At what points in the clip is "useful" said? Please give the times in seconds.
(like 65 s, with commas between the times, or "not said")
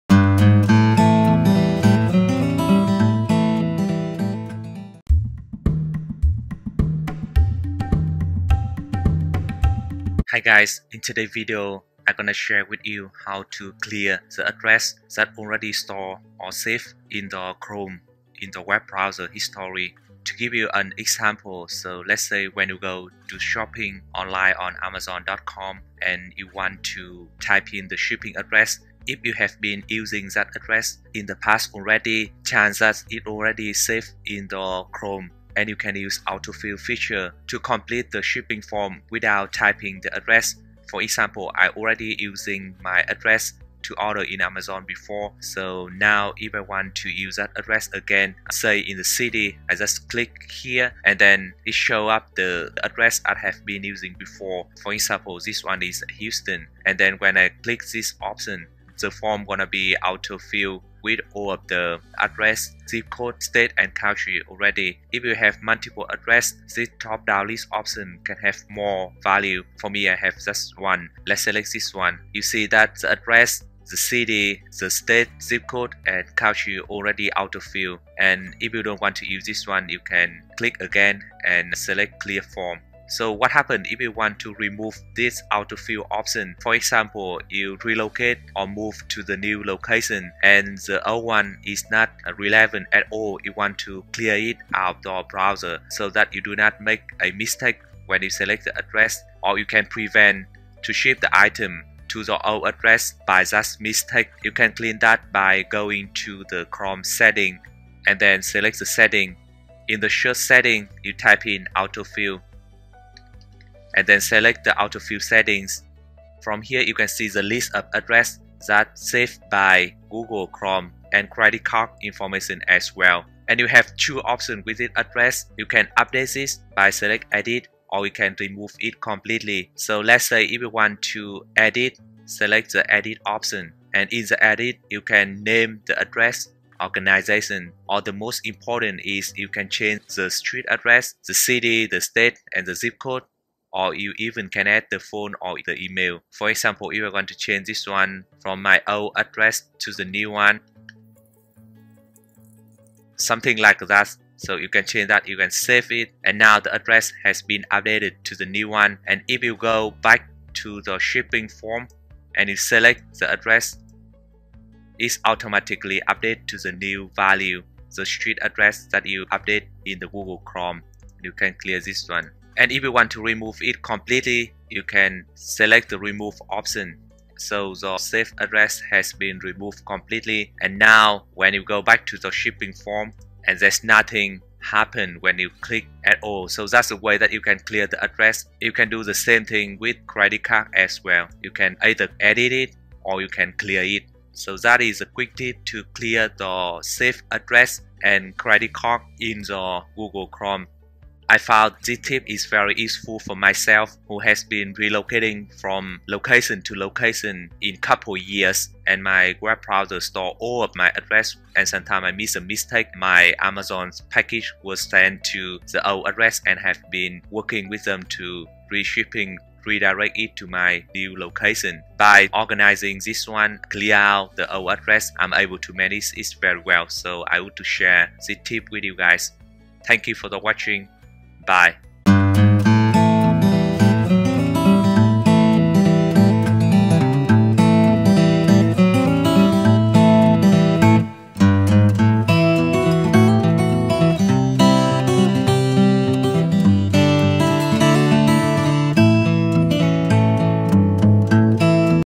202 s.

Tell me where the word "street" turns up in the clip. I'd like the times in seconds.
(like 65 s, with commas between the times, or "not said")
140 s, 168 s.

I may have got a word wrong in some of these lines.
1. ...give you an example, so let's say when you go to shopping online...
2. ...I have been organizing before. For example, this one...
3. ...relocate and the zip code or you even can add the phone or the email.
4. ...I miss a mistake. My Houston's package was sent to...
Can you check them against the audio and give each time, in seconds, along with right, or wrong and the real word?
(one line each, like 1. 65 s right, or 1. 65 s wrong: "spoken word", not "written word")
1. 20 s right
2. 53 s wrong: "using", not "organizing"
3. 142 s wrong: "state", not "relocate"
4. 212 s wrong: "Amazon", not "Houston".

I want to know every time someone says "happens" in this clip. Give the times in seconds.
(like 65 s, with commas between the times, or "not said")
83 s, 184 s.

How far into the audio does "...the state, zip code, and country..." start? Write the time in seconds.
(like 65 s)
74 s.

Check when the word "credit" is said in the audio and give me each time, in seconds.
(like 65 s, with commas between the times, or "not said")
121 s, 190 s, 198 s.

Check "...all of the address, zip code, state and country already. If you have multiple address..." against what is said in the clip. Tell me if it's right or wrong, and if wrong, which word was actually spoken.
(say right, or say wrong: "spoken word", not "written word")
right.